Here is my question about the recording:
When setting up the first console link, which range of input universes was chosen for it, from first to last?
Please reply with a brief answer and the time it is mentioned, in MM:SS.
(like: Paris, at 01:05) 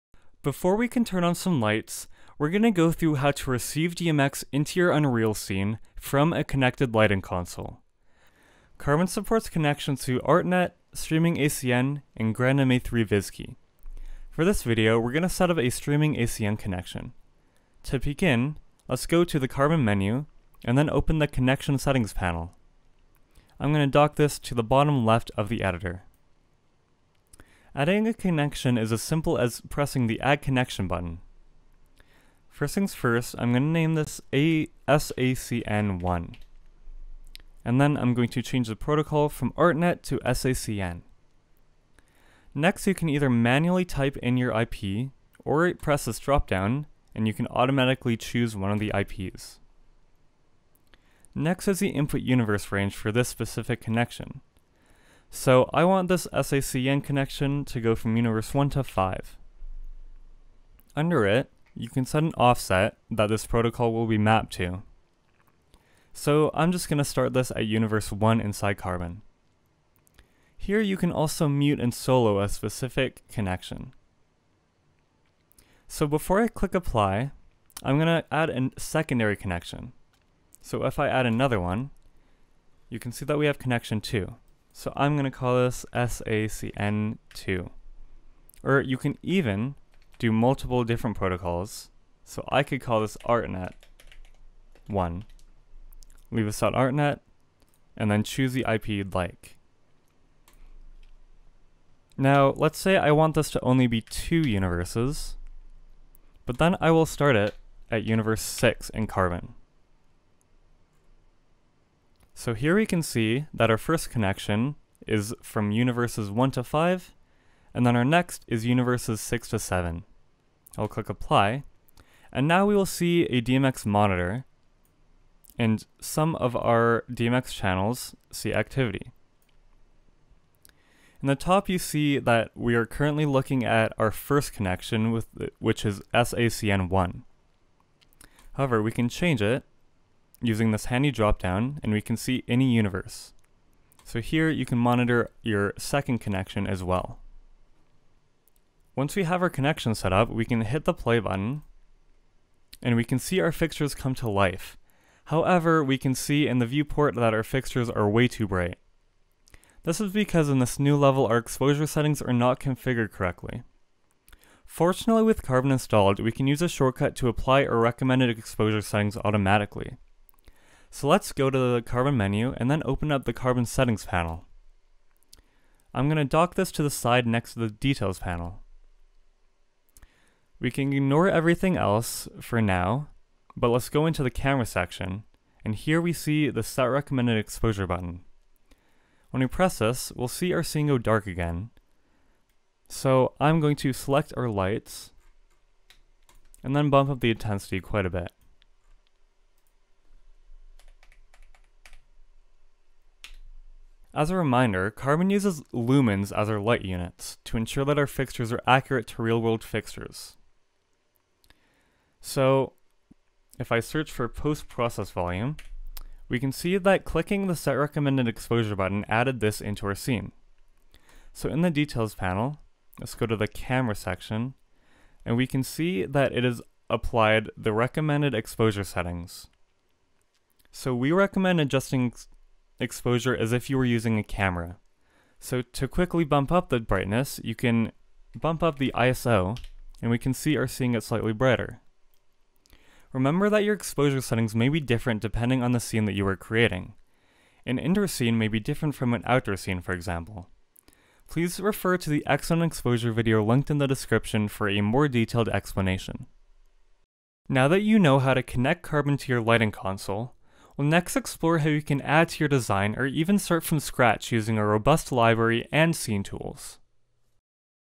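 1 to 5, at 00:58.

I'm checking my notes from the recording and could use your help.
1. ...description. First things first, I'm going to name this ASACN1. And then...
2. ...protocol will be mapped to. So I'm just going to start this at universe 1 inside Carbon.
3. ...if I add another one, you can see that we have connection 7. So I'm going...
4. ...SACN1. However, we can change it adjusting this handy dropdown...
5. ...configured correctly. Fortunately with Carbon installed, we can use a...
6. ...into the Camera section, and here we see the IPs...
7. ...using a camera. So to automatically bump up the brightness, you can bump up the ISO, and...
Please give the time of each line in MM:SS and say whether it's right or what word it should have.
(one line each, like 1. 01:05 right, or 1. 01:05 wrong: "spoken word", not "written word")
1. 00:30 wrong: "button", not "description"
2. 01:03 right
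3. 01:20 wrong: "2", not "7"
4. 02:16 wrong: "using", not "adjusting"
5. 02:42 right
6. 03:04 wrong: "Set", not "IPs"
7. 03:53 wrong: "quickly", not "automatically".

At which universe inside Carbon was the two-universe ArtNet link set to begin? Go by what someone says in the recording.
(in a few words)
6.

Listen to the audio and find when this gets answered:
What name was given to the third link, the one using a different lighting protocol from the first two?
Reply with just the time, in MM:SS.
01:33.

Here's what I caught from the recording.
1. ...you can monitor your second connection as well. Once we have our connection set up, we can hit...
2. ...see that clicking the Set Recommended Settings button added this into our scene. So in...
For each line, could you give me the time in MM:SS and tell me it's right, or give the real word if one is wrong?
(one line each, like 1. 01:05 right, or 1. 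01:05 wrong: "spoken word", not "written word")
1. 02:24 right
2. 03:36 wrong: "Exposure", not "Settings".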